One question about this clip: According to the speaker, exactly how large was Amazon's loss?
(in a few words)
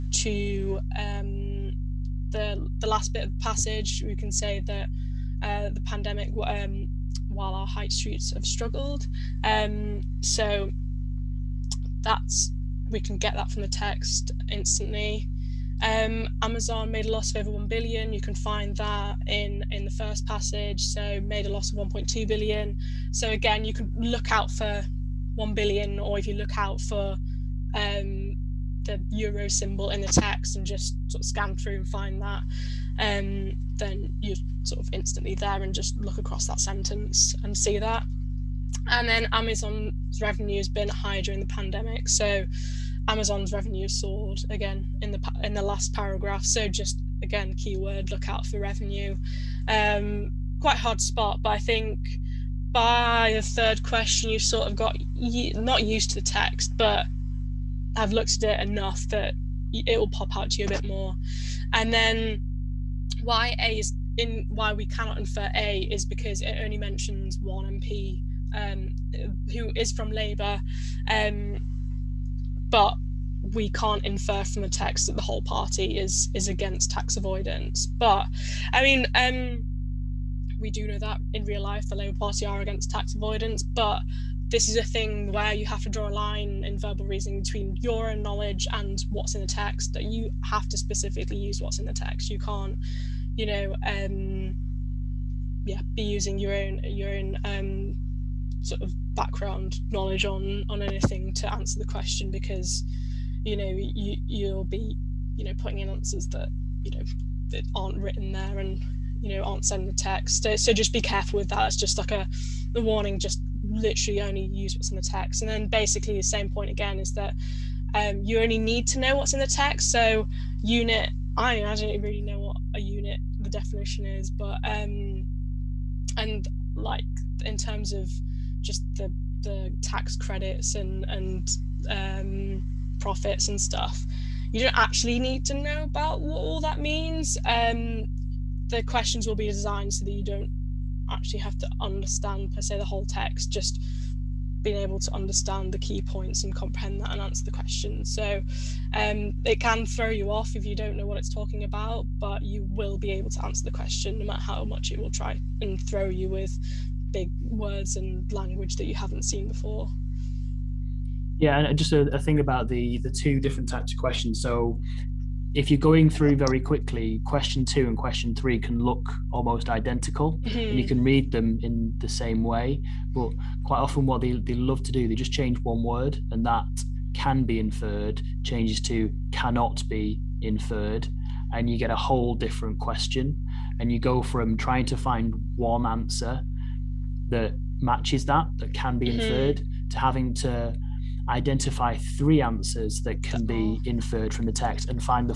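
1.2 billion.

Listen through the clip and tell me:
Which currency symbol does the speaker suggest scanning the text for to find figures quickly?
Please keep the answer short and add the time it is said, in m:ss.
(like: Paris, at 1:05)
euro, at 0:29.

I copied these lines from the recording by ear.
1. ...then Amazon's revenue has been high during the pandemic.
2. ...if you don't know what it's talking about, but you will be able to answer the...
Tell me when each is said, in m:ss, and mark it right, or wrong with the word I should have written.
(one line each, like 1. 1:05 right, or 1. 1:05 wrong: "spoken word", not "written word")
1. 0:39 right
2. 2:30 right.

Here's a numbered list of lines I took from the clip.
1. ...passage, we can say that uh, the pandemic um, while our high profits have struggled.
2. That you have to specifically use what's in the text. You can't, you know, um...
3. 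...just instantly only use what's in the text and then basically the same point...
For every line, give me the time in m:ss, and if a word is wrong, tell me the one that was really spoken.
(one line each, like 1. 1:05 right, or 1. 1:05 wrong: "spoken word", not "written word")
1. 0:03 wrong: "streets", not "profits"
2. 1:29 right
3. 1:53 wrong: "literally", not "instantly".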